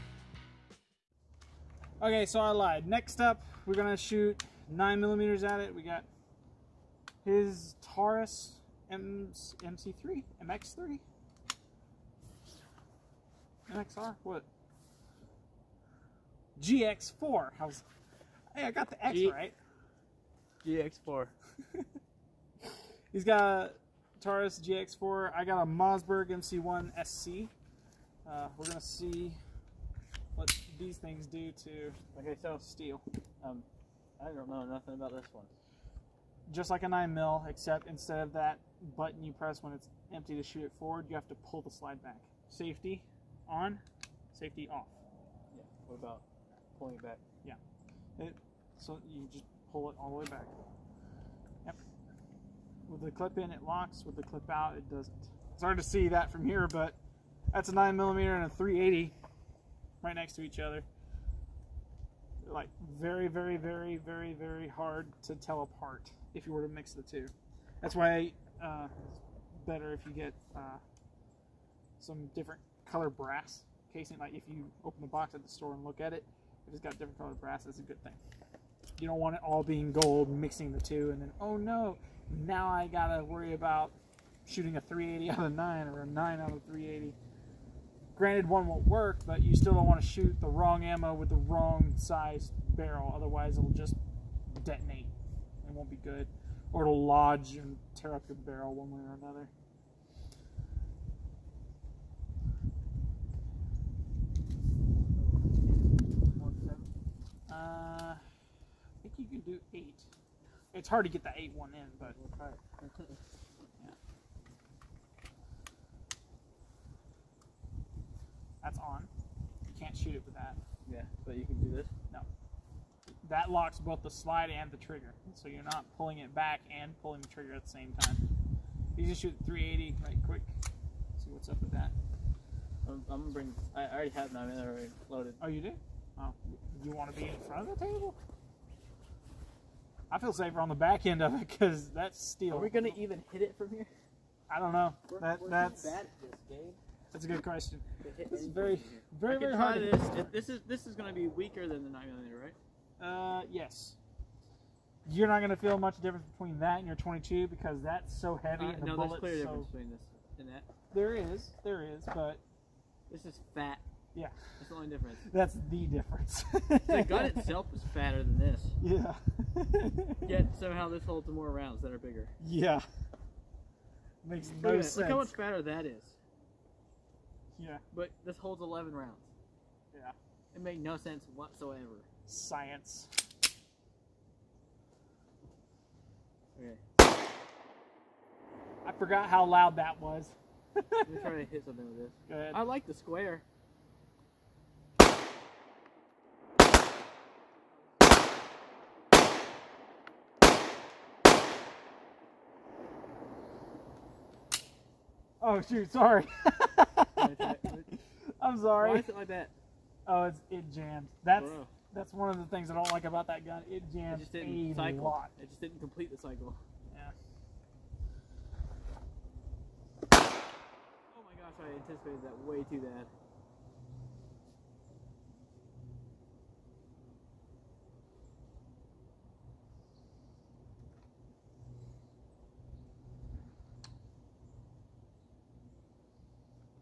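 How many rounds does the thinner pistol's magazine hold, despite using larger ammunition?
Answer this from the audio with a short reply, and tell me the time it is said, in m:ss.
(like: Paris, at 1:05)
11, at 2:57.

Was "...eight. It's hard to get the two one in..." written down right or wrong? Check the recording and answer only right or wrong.
wrong.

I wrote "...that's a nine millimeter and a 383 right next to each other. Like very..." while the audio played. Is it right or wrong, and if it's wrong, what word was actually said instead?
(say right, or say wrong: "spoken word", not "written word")
wrong: "380", not "383".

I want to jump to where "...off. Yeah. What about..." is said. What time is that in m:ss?
0:44.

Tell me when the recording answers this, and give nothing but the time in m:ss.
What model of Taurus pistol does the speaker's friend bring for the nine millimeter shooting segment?
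0:23.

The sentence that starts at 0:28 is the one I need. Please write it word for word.
Uh, we're gonna see these things do to okay, so steel.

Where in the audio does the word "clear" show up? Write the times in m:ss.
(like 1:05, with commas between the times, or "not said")
2:39.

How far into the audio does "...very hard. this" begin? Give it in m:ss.
2:29.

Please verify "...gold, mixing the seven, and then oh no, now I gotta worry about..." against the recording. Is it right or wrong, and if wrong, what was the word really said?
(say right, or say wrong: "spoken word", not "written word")
wrong: "two", not "seven".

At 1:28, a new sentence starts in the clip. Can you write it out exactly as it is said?
Granted, one won't work, but you still don't want to shoot the wrong ammo with the wrong size barrel.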